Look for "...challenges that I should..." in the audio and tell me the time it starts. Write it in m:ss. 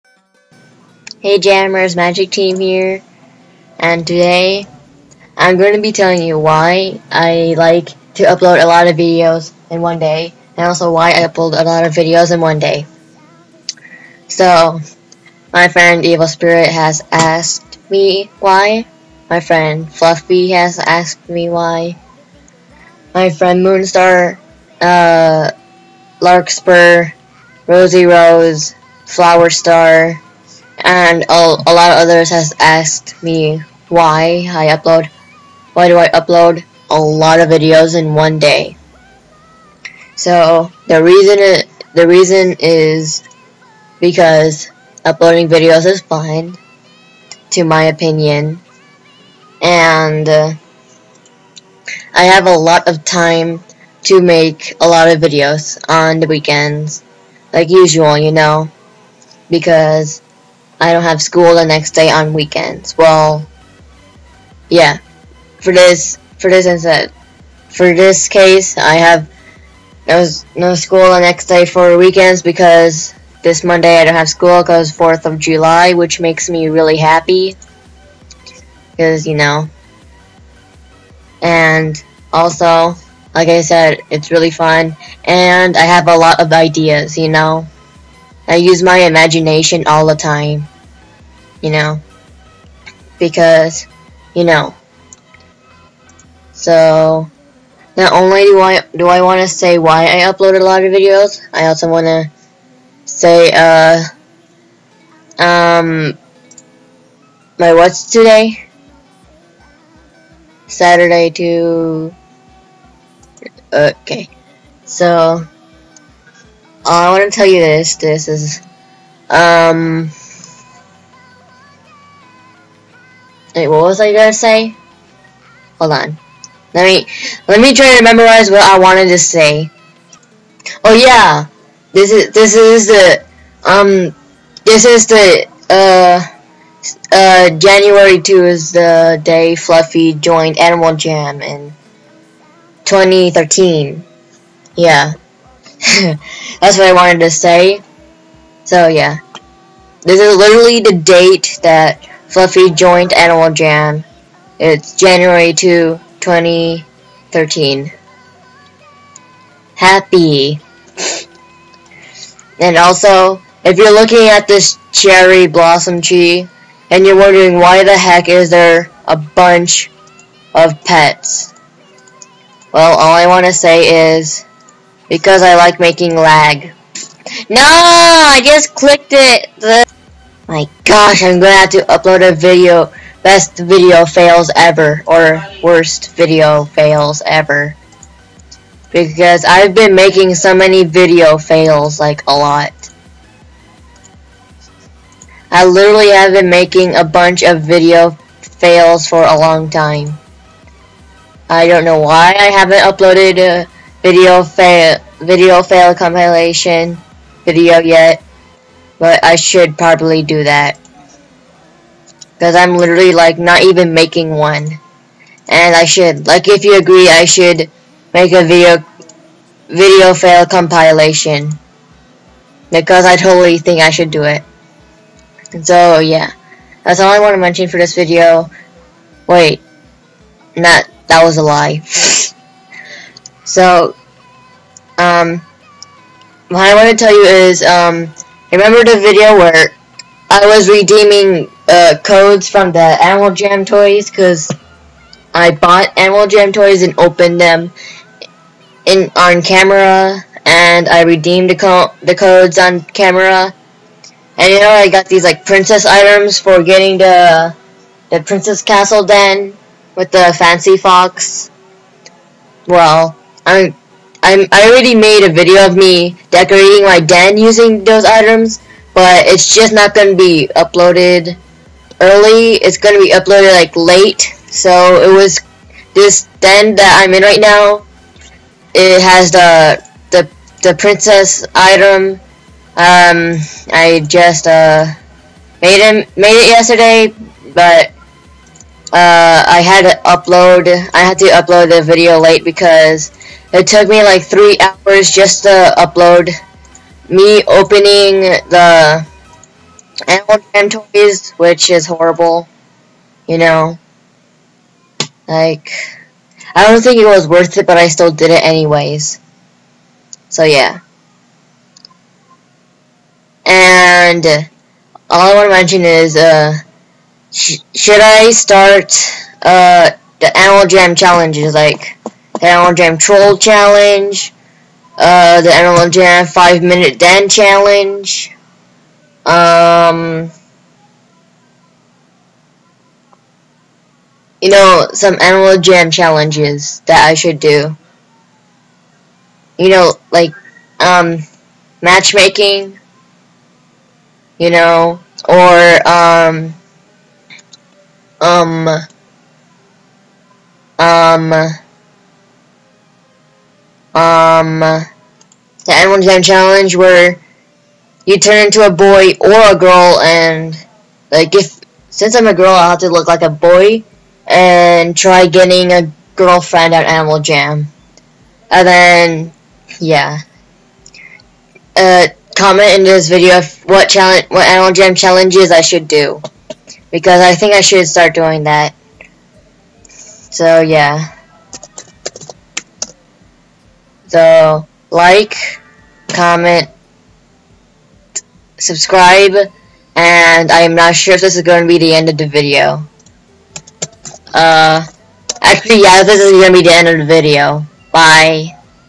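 5:35.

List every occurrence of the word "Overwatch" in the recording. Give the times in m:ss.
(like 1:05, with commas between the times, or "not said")
not said.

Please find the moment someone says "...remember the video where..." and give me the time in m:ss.
3:58.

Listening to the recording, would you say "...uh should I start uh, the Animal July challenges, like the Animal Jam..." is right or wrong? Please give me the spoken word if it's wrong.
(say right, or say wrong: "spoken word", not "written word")
wrong: "Jam", not "July".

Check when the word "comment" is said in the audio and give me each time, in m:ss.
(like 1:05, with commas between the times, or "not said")
6:12, 6:26.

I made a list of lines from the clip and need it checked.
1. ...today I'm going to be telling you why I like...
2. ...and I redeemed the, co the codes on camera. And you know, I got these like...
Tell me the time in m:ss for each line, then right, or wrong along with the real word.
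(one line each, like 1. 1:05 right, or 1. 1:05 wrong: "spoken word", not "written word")
1. 0:04 right
2. 4:10 right.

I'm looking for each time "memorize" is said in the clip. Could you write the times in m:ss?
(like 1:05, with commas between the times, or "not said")
2:08.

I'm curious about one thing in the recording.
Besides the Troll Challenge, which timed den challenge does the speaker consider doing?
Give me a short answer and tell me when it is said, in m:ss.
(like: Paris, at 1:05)
5 Minute Den Challenge, at 5:26.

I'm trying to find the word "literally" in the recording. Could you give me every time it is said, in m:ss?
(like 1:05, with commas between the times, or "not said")
2:30, 3:15, 3:32.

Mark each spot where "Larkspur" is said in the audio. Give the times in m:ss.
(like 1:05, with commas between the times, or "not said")
0:26.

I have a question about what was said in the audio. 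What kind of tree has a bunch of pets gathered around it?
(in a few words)
Cherry blossom tree.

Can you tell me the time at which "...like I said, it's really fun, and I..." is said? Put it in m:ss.
1:23.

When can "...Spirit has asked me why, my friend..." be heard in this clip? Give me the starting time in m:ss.
0:16.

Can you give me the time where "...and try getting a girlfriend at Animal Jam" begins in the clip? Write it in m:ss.
6:04.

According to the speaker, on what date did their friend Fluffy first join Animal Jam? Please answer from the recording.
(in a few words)
January 2, 2013.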